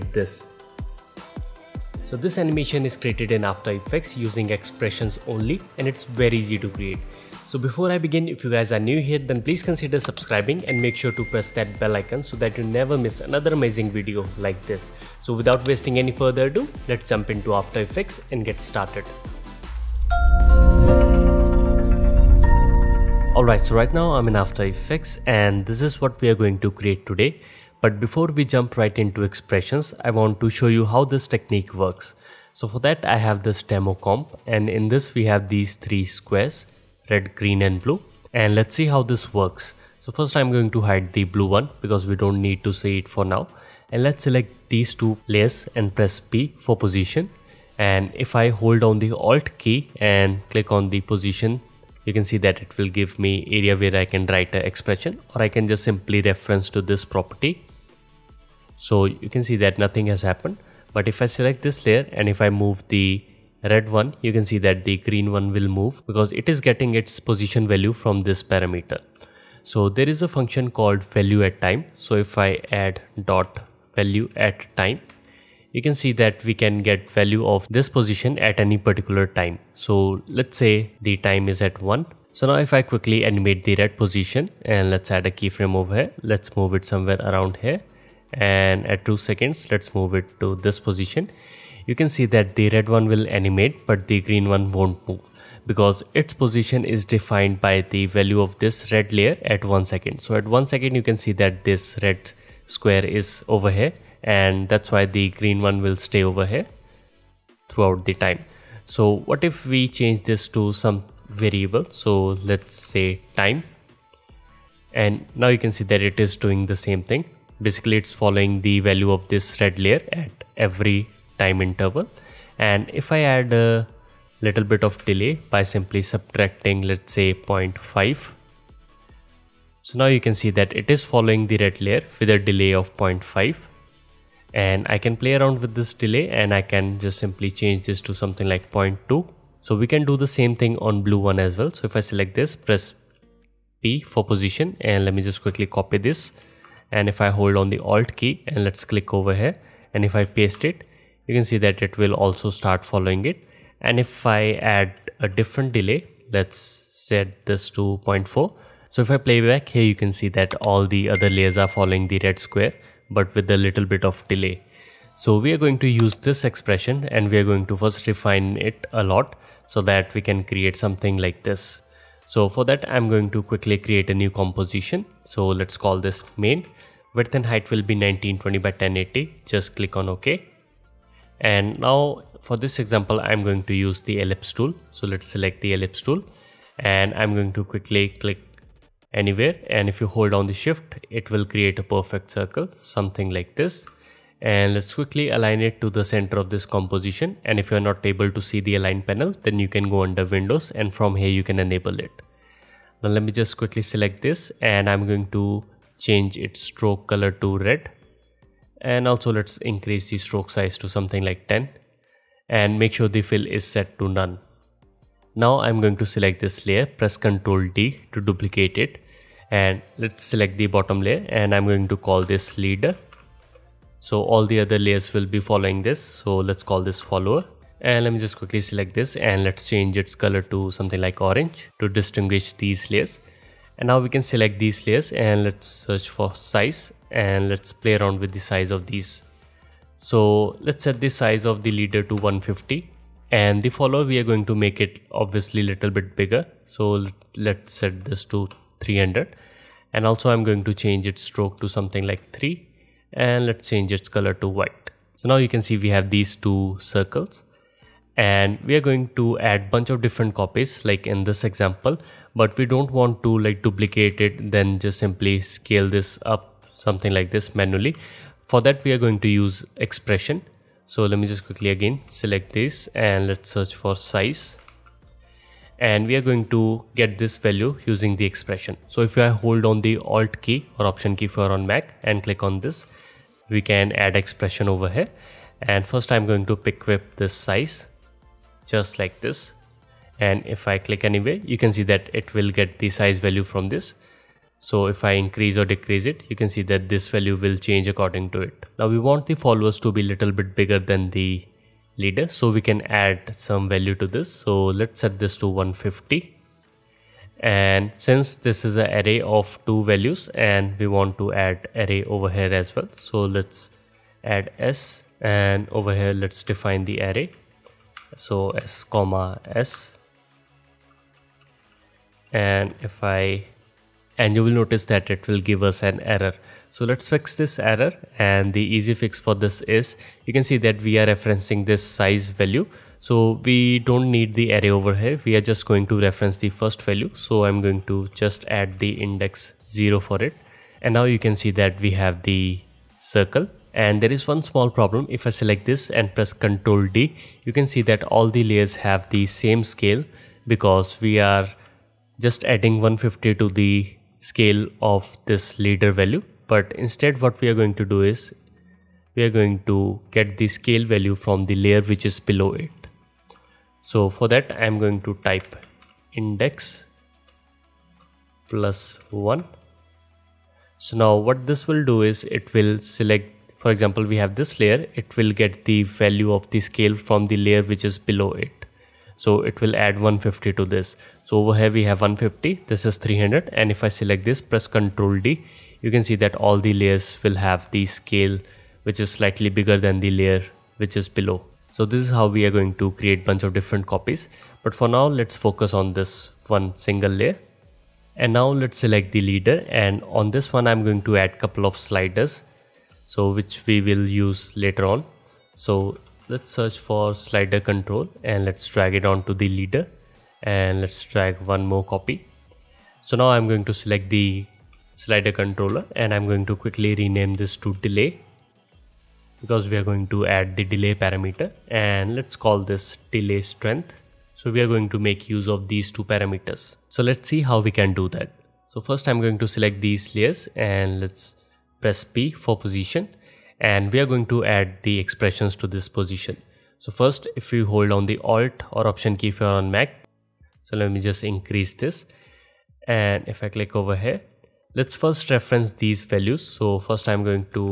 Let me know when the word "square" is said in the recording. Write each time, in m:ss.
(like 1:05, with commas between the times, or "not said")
0:36, 1:42, 2:42.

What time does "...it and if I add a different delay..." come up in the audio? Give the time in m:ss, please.
2:33.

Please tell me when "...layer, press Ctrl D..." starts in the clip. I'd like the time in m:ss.
3:36.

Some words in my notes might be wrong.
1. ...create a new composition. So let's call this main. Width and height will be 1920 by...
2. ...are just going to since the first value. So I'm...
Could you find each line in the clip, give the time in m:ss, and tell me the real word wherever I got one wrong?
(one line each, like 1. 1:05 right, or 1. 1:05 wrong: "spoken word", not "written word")
1. 2:53 right
2. 5:35 wrong: "reference", not "since".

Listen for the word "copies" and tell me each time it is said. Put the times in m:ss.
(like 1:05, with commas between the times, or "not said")
4:20, 6:33.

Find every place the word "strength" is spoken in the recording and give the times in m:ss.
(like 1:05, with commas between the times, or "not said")
7:03.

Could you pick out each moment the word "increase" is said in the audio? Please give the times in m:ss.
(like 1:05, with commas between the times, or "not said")
3:29, 4:55, 7:21.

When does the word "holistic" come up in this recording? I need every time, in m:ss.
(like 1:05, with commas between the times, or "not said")
not said.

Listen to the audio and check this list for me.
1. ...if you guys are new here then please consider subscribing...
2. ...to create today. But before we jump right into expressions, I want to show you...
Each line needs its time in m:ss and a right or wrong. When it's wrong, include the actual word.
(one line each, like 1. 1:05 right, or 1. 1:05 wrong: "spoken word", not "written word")
1. 0:08 right
2. 0:26 right.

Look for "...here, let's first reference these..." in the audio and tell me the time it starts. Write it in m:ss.
7:23.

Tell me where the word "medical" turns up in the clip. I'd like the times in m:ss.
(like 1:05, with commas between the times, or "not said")
not said.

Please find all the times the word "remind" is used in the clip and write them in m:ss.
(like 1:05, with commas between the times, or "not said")
not said.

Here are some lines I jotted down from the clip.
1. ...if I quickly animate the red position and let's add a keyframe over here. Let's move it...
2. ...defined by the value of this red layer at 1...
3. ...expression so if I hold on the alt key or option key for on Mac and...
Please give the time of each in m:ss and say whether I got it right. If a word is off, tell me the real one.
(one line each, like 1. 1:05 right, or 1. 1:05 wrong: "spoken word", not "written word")
1. 1:22 right
2. 1:37 right
3. 4:38 right.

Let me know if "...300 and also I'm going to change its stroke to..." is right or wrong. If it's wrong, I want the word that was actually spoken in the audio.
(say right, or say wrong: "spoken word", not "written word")
right.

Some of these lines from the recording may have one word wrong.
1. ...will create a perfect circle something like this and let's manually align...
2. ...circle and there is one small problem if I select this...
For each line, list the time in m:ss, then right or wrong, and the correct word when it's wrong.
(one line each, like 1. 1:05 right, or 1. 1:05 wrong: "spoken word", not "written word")
1. 3:11 wrong: "quickly", not "manually"
2. 5:42 right.